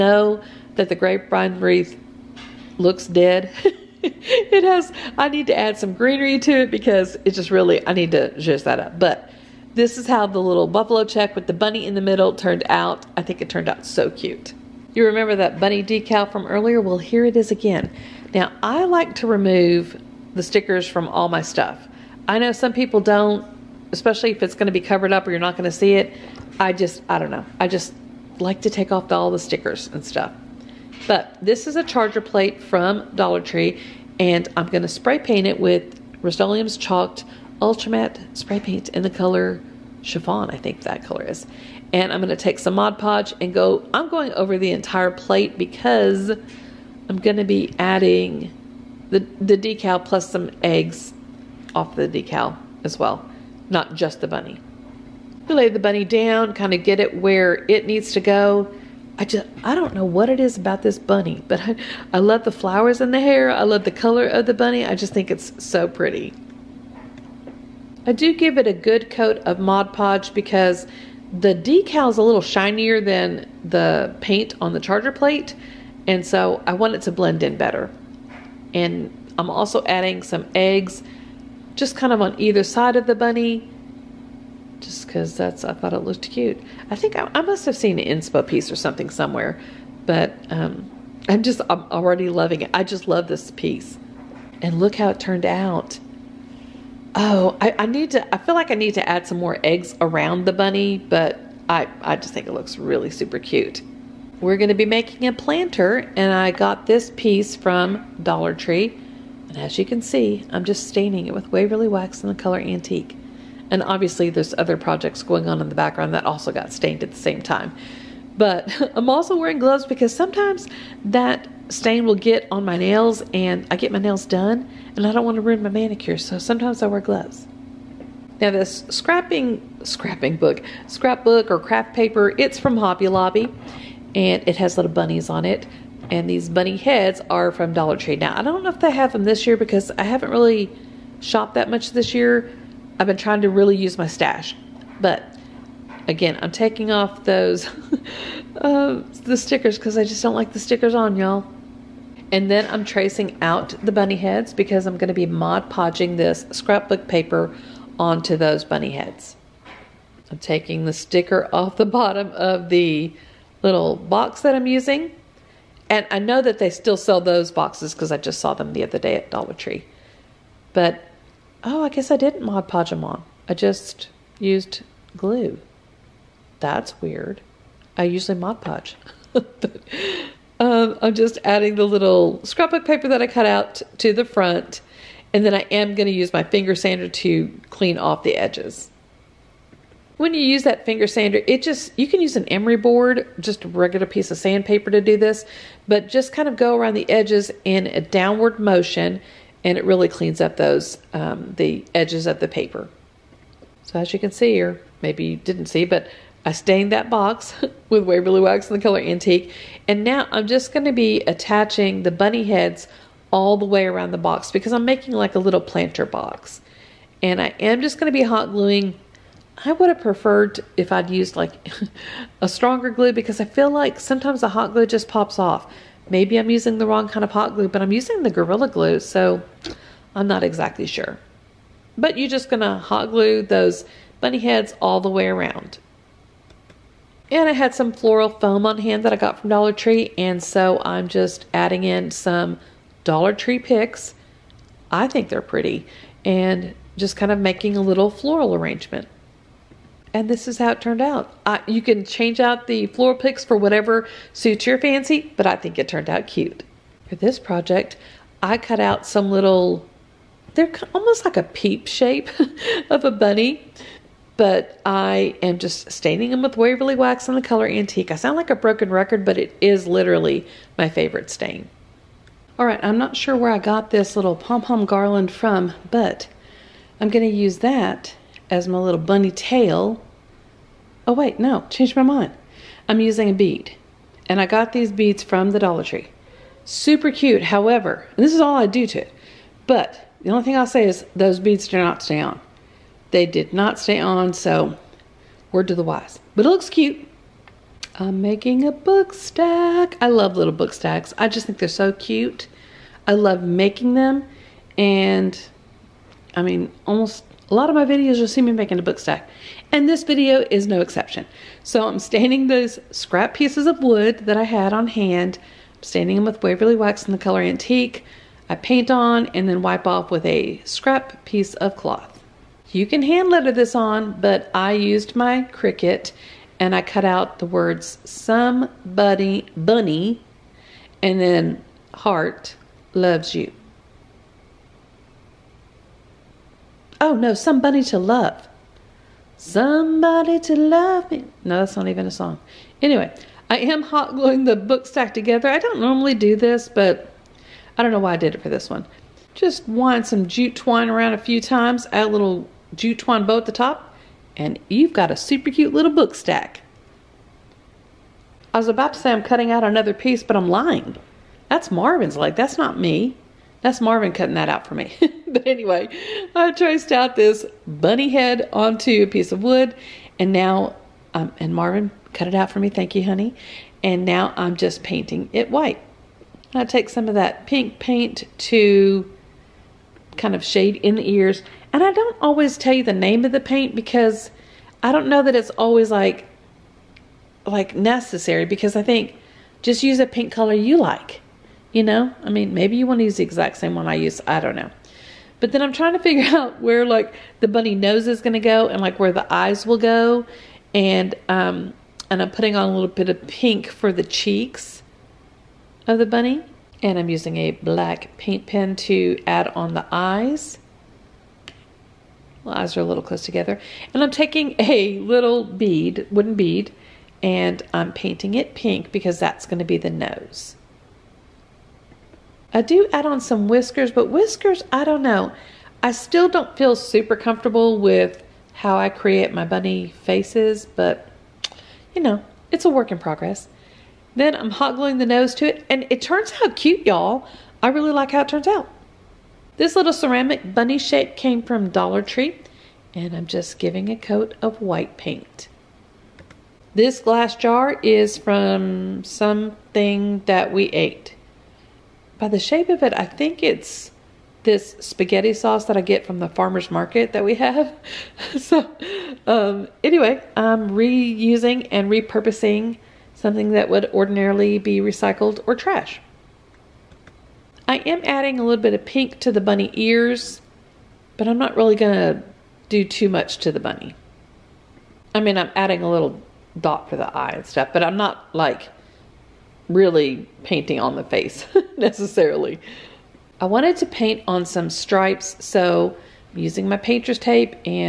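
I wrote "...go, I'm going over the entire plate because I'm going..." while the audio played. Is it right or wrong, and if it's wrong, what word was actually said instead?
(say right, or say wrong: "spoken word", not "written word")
right.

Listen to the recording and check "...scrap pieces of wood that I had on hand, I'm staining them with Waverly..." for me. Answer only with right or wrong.
right.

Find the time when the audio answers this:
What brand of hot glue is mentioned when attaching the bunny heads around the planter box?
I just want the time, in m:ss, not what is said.
3:48.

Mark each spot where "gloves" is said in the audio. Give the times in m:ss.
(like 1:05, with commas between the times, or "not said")
1:59, 2:07.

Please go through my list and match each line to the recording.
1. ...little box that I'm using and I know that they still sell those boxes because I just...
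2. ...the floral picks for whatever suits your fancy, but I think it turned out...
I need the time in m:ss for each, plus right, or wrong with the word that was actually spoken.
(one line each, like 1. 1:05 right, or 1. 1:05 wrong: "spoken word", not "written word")
1. 2:43 right
2. 4:12 right.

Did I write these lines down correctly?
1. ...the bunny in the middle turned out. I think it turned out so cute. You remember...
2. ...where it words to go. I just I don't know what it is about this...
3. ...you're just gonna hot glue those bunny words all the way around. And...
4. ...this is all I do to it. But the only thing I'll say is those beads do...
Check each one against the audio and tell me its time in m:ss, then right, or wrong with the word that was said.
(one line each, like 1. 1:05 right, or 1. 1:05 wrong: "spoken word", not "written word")
1. 0:11 right
2. 0:57 wrong: "needs", not "words"
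3. 3:52 wrong: "heads", not "words"
4. 4:48 right.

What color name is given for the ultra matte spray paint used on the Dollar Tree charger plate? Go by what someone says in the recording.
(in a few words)
Chiffon.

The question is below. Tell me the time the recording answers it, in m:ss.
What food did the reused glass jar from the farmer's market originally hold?
7:34.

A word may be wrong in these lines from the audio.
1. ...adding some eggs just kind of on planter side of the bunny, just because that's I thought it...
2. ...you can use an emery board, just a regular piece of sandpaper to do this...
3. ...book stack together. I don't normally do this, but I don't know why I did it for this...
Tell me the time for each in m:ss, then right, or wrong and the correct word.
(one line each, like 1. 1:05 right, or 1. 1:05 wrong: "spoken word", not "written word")
1. 1:19 wrong: "either", not "planter"
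2. 3:11 right
3. 5:44 right.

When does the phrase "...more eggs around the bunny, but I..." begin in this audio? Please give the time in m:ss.
1:39.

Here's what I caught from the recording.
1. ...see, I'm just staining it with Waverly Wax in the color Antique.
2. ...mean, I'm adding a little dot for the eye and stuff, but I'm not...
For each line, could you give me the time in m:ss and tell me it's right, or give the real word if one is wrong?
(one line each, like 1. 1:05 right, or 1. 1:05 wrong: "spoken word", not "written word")
1. 1:50 right
2. 7:55 right.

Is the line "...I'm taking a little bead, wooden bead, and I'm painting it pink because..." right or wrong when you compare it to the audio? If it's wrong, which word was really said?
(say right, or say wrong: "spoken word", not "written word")
right.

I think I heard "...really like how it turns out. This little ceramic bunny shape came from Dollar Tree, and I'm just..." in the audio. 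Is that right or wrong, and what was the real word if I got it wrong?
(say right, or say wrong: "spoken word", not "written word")
right.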